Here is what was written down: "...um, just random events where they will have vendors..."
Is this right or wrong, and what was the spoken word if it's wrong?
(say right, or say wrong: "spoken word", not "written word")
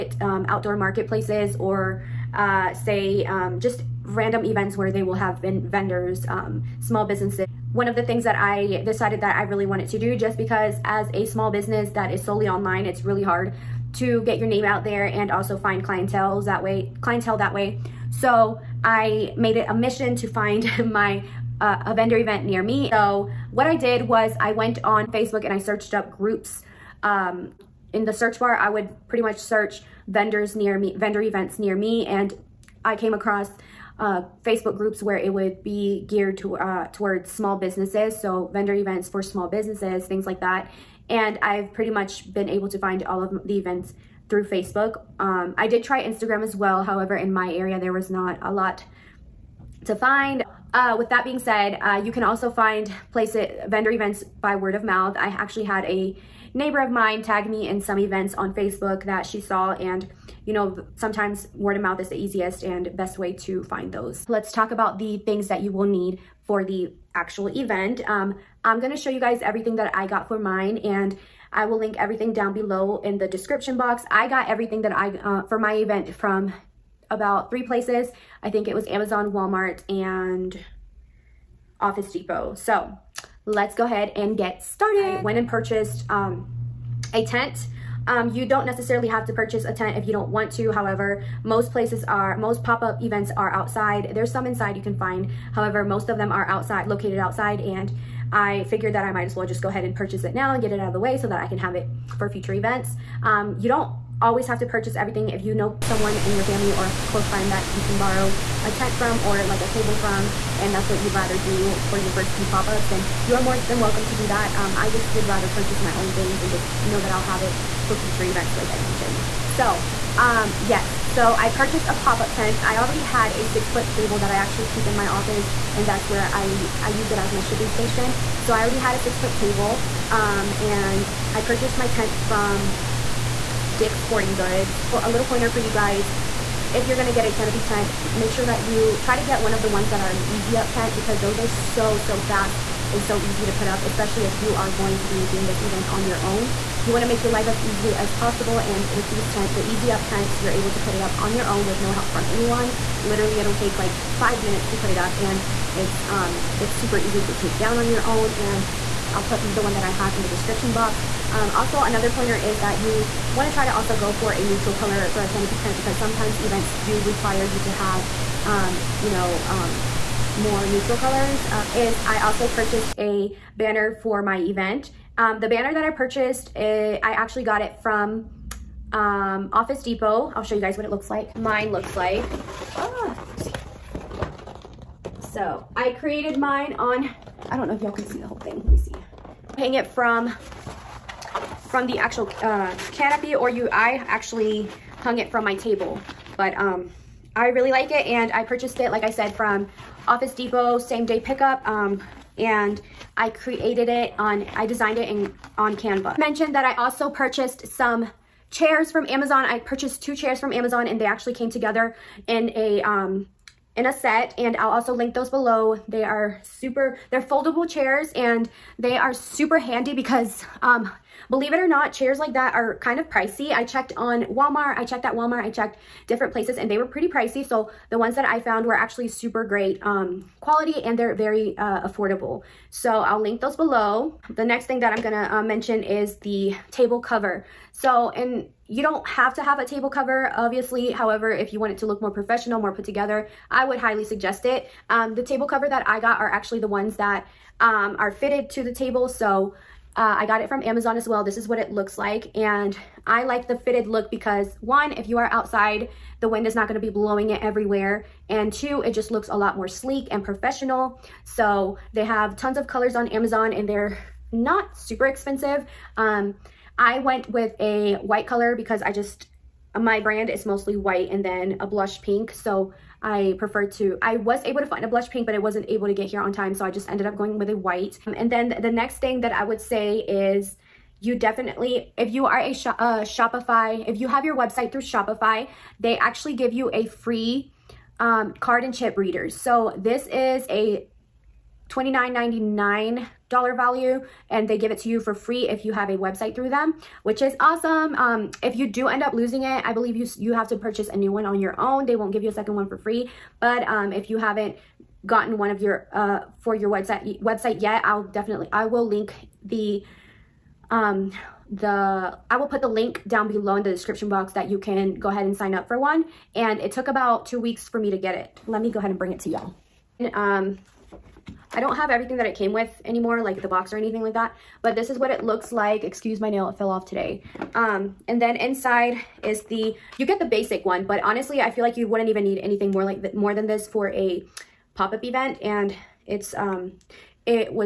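right.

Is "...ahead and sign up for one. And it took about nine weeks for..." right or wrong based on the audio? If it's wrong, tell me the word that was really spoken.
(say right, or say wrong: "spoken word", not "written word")
wrong: "two", not "nine".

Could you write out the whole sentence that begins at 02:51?
Uh, is I also purchased a banner for my event.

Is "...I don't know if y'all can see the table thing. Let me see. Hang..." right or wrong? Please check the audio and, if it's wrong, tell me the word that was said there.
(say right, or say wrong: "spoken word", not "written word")
wrong: "whole", not "table".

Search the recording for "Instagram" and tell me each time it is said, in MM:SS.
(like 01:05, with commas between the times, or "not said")
00:46.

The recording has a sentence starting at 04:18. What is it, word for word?
And two, it just looks a lot more sleek and professional.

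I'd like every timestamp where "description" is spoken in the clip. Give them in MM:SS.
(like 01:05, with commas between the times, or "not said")
01:13, 02:40, 05:13.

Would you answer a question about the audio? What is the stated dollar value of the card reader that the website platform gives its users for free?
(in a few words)
$29.99.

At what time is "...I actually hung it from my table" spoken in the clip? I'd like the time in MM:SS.
03:13.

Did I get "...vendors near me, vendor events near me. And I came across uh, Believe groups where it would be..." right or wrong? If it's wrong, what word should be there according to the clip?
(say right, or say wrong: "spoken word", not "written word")
wrong: "Facebook", not "Believe".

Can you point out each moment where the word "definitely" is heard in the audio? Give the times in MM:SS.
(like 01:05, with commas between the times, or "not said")
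04:41, 05:08.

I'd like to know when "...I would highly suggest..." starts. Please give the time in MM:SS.
04:03.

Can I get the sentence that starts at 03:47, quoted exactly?
So the ones that I found were actually super great um, quality and they're very uh, affordable.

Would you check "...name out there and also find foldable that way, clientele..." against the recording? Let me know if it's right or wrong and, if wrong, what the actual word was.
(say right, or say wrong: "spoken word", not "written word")
wrong: "clientele", not "foldable".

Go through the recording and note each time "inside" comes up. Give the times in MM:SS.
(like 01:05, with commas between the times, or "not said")
01:34, 05:28.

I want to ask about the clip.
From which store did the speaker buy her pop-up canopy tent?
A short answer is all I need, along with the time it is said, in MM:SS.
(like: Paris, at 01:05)
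Dick's Sporting Goods, at 02:13.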